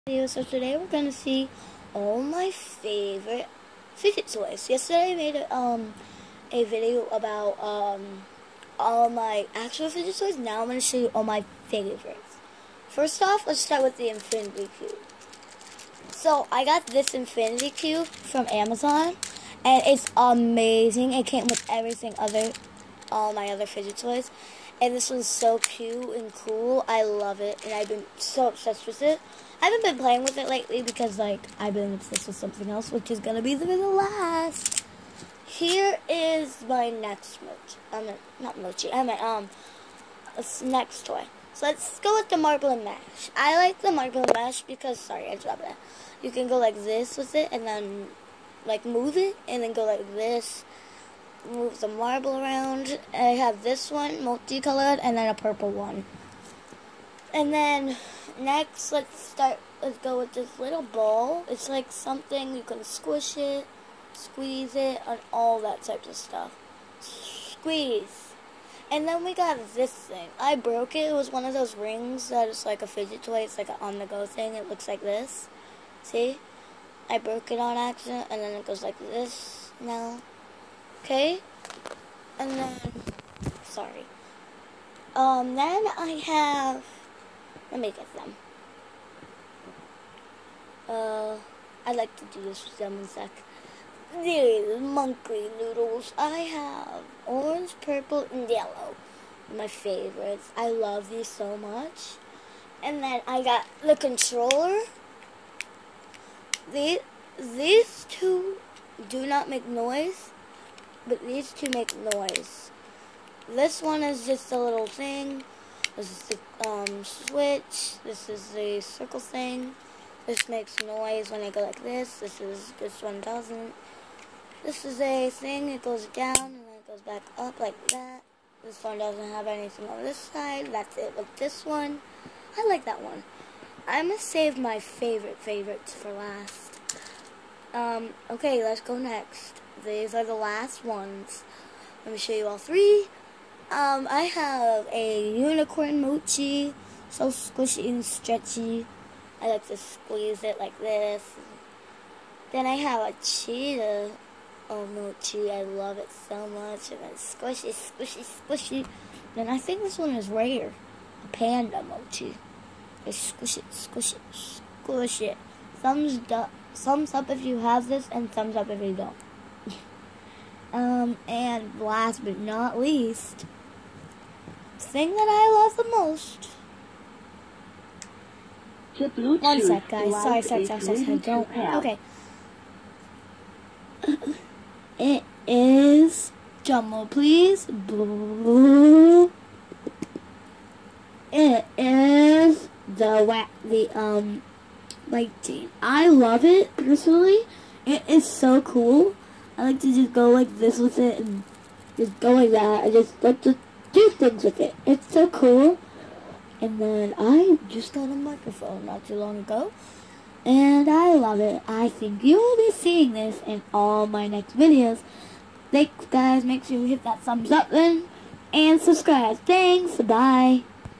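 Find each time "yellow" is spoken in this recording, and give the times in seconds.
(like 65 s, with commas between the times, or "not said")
98 s.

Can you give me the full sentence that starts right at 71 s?
It was one of those rings that is like a fidget toy.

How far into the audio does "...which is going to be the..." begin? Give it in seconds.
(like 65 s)
32 s.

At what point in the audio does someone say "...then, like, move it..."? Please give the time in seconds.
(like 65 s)
47 s.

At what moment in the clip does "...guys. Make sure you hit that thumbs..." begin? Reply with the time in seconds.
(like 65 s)
216 s.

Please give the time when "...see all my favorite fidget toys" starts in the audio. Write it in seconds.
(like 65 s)
1 s.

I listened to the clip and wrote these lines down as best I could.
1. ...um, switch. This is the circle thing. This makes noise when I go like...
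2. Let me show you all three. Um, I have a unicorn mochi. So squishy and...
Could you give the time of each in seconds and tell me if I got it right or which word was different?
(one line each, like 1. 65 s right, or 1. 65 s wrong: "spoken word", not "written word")
1. 116 s right
2. 142 s right.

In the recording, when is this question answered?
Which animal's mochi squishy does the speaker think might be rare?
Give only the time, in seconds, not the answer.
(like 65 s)
161 s.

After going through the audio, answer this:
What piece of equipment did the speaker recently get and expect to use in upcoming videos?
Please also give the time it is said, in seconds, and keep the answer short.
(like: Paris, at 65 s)
microphone, at 208 s.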